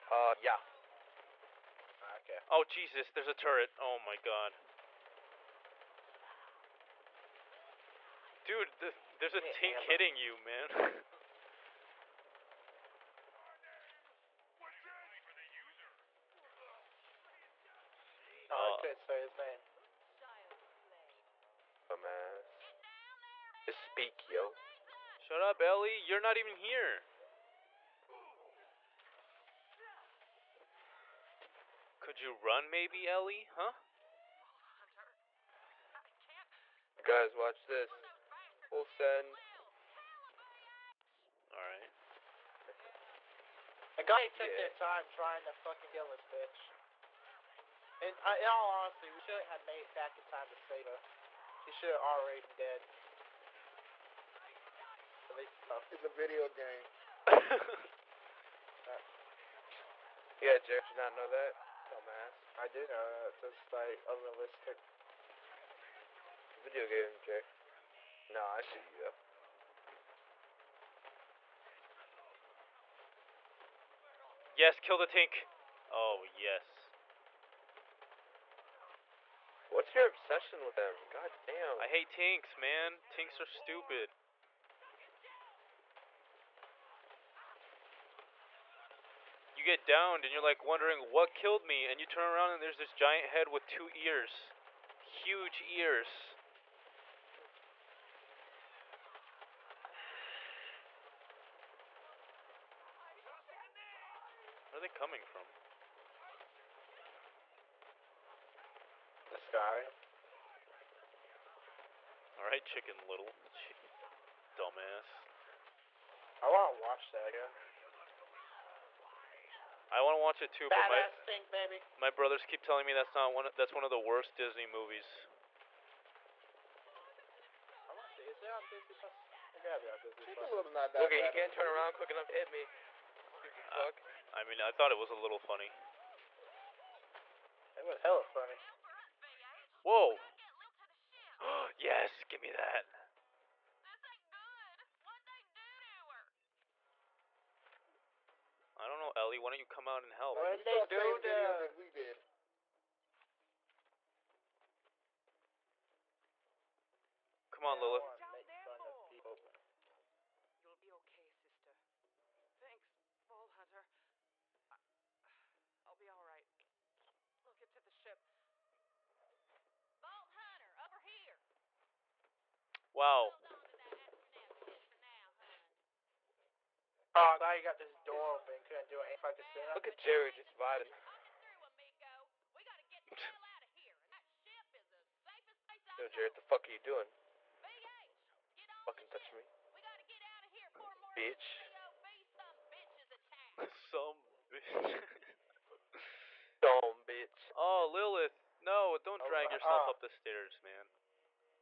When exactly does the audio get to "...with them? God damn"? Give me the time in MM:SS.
01:20.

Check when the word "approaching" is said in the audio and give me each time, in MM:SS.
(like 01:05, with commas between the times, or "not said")
not said.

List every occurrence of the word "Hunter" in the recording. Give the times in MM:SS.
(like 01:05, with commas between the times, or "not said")
02:43, 02:50.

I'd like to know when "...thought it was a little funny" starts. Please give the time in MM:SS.
02:14.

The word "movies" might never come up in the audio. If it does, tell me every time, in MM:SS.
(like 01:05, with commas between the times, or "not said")
02:04, 02:11.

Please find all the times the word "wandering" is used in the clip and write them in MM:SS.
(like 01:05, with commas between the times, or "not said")
not said.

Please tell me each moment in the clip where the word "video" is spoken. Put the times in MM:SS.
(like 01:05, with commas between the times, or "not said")
00:56, 01:06, 02:31.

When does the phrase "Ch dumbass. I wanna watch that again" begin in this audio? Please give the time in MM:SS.
01:53.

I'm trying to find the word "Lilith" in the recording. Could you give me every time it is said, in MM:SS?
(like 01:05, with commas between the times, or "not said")
02:37, 03:17.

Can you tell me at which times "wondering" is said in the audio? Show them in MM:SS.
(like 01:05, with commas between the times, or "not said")
01:30.